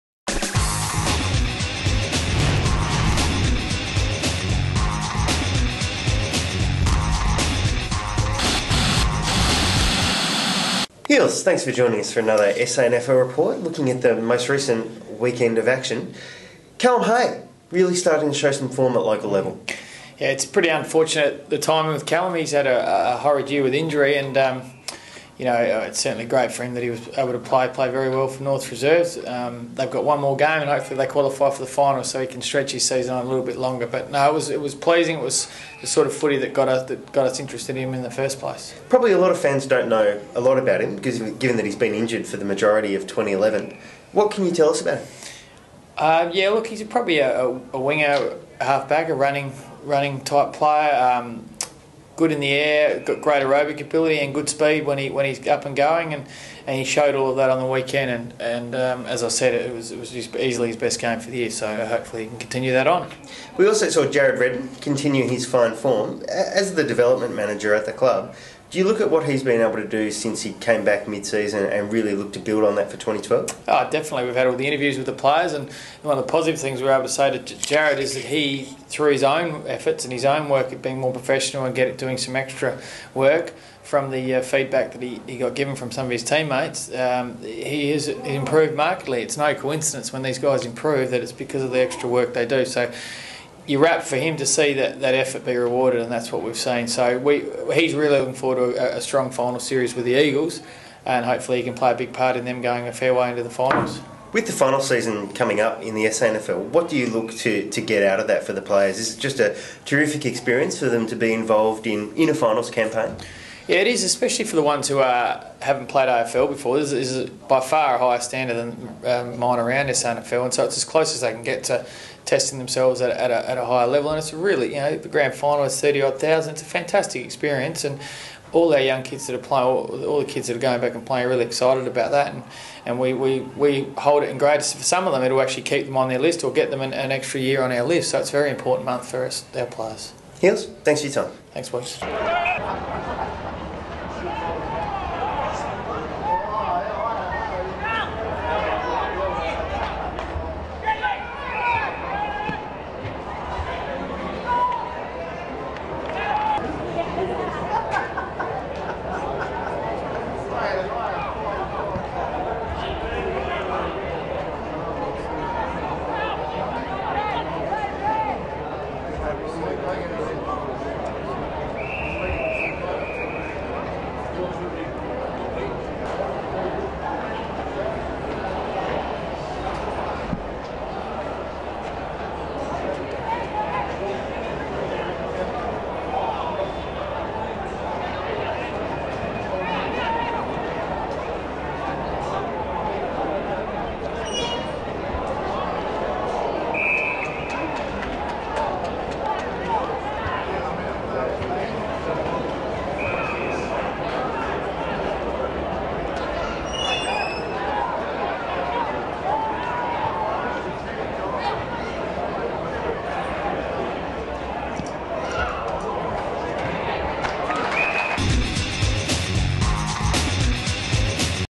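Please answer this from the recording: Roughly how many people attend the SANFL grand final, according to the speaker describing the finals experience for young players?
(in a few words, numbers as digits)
30,000.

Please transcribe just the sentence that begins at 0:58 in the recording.
And and um, as I said, it was it was easily his best game for the year.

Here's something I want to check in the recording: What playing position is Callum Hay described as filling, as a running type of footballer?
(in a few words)
Winger.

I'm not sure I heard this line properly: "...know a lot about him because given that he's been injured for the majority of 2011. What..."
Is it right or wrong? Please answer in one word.
right.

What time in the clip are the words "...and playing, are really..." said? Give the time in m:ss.
2:10.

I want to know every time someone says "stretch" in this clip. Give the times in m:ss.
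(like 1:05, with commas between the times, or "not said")
0:32.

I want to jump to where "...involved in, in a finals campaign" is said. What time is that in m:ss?
1:51.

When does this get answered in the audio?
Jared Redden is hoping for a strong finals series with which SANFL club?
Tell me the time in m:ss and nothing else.
1:40.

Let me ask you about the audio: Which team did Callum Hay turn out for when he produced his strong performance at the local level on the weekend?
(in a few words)
North Reserves.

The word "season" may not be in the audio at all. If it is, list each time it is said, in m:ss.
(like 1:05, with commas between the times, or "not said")
0:32, 1:11, 1:44.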